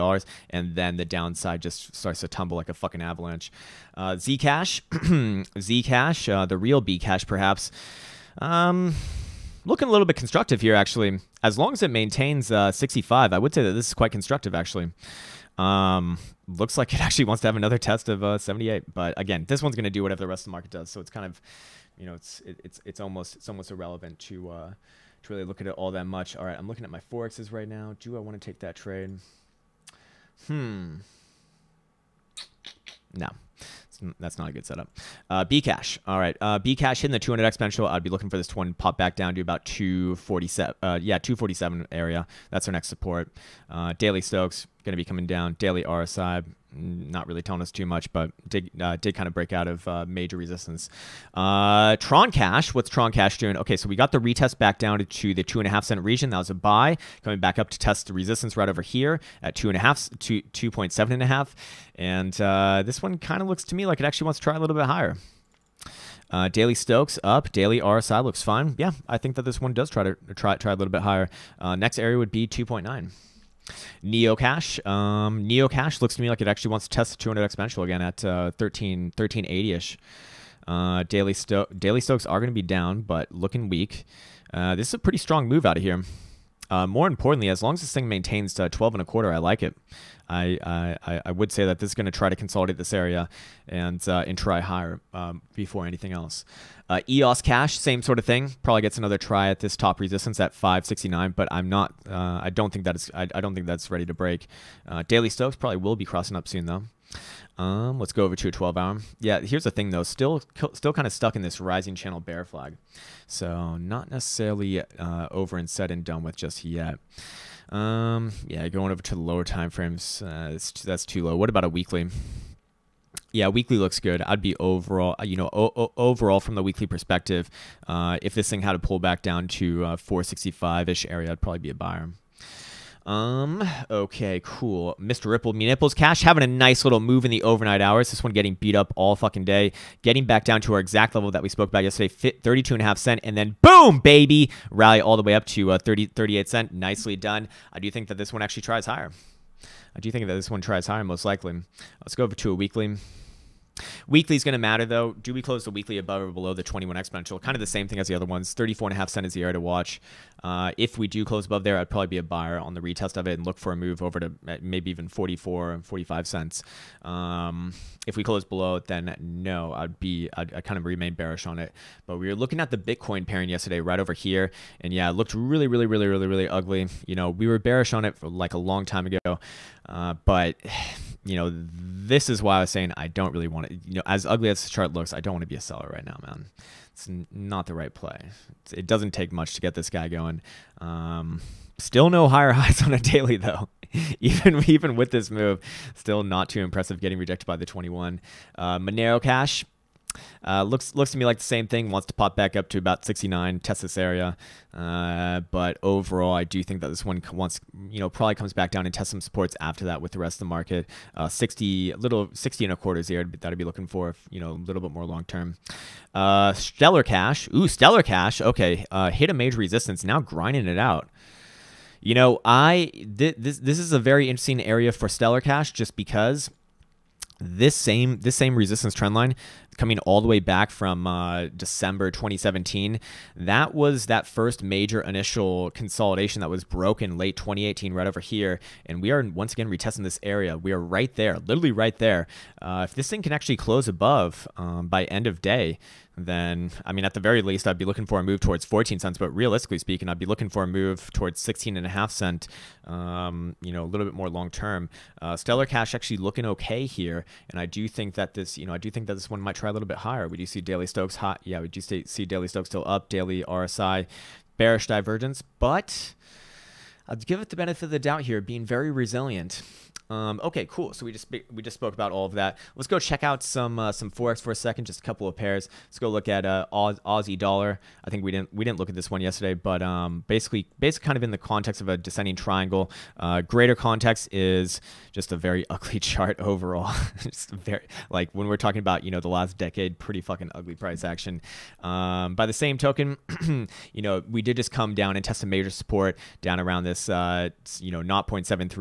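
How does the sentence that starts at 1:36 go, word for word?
Uh, EOS Cash, same sort of thing.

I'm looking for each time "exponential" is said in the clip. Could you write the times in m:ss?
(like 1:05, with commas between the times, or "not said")
0:37, 1:17, 2:36.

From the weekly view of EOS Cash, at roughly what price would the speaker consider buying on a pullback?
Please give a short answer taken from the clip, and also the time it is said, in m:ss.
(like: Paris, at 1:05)
465, at 2:09.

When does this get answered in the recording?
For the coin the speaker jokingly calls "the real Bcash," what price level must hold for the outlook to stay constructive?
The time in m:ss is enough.
0:12.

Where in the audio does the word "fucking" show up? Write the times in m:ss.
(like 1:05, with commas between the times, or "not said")
0:02, 2:19, 4:50.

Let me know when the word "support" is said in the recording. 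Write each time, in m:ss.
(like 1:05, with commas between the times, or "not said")
0:42, 3:29, 4:55.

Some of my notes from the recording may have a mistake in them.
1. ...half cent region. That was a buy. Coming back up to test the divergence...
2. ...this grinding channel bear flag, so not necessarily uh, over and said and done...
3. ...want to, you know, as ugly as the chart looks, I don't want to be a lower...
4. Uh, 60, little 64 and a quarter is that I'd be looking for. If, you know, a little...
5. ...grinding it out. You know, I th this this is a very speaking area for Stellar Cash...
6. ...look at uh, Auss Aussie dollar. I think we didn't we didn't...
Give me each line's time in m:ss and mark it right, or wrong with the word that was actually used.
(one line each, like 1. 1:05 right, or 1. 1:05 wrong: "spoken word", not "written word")
1. 0:55 wrong: "resistance", not "divergence"
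2. 1:51 wrong: "rising", not "grinding"
3. 3:03 wrong: "seller", not "lower"
4. 3:31 wrong: "60", not "64"
5. 3:40 wrong: "interesting", not "speaking"
6. 4:36 right.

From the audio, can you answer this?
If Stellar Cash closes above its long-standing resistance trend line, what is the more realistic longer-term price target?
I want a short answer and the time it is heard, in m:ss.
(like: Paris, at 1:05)
16.5 cents, at 4:11.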